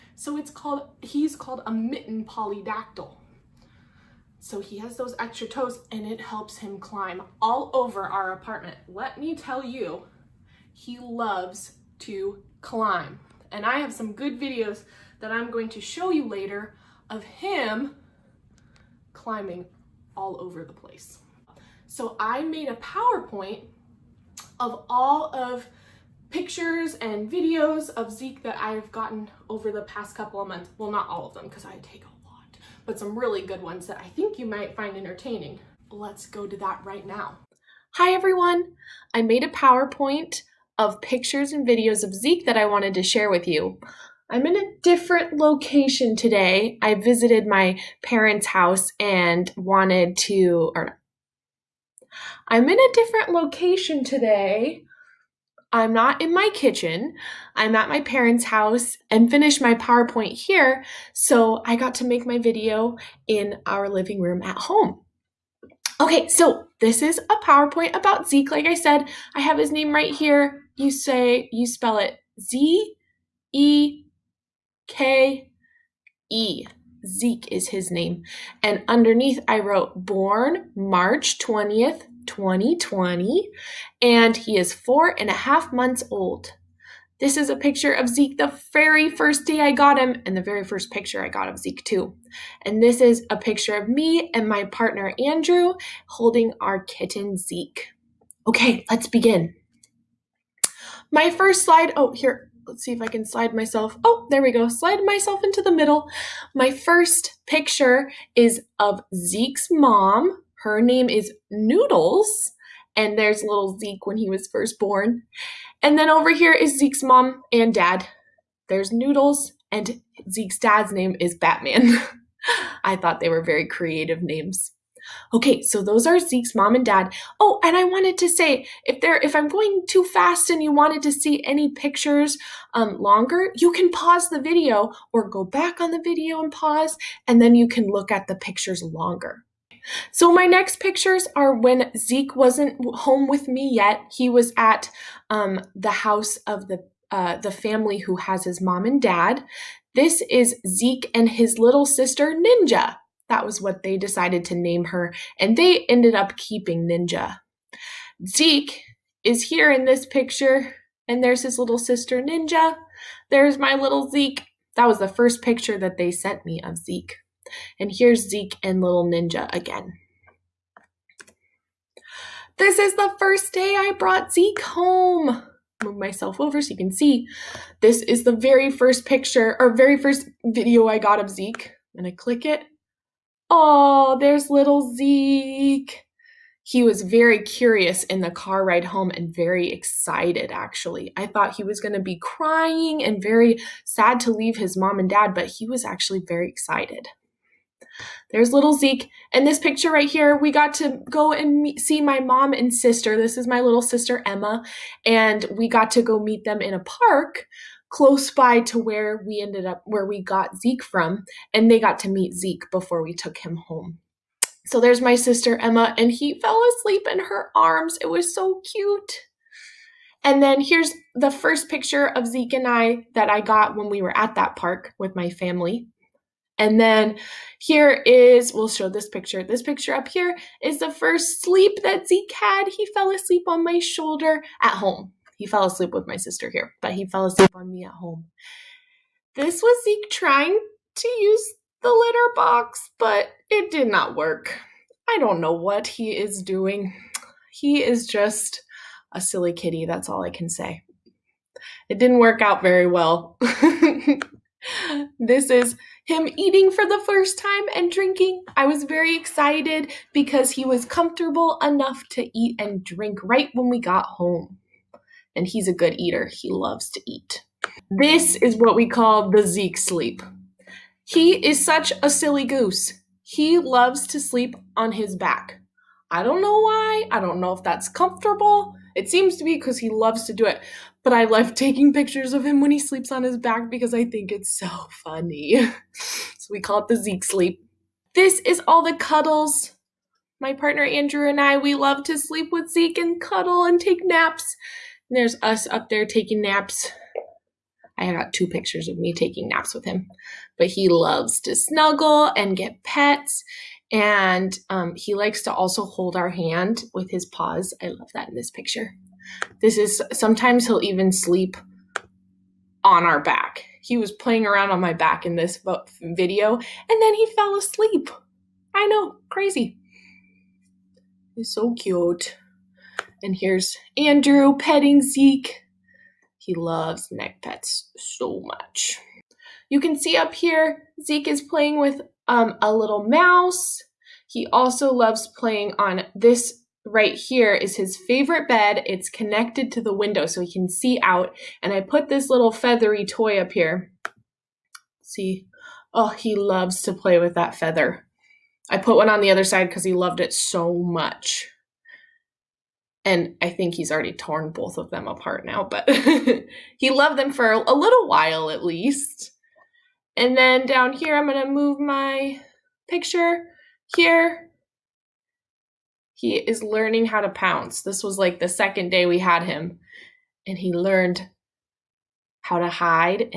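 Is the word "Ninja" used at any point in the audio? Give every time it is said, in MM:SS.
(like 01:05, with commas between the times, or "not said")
02:32, 02:36, 02:42, 02:49.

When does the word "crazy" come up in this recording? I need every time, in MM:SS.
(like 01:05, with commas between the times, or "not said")
05:19.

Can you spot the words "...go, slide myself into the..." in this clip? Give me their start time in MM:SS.
01:44.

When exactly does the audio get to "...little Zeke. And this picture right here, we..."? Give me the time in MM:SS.
03:18.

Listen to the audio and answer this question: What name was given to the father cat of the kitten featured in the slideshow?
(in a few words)
Batman.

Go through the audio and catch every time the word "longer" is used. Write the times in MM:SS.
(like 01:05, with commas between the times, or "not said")
02:12, 02:18.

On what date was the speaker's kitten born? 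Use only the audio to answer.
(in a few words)
March 20, 2020.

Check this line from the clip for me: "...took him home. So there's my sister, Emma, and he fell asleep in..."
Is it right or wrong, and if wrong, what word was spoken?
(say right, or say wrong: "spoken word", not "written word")
right.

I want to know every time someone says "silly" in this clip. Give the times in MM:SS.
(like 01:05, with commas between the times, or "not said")
04:09, 04:32.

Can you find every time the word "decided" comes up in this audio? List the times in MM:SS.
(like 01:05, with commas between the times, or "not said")
02:33.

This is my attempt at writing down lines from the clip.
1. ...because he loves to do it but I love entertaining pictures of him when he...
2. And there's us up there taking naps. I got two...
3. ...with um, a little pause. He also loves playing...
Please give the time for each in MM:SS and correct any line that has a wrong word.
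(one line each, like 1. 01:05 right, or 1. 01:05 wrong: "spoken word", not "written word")
1. 04:39 wrong: "taking", not "entertaining"
2. 04:55 right
3. 05:31 wrong: "mouse", not "pause".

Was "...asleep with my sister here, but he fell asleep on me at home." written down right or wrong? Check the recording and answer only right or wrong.
right.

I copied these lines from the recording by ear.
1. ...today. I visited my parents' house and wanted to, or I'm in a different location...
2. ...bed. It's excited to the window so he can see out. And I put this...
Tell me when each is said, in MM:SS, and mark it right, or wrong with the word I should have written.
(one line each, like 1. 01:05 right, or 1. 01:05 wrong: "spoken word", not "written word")
1. 00:46 right
2. 05:38 wrong: "connected", not "excited".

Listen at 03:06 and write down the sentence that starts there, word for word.
He was very curious in the car ride home and very excited, actually.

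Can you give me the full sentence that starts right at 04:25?
And he's a good eater, he loves to eat.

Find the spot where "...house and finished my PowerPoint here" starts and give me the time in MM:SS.
00:58.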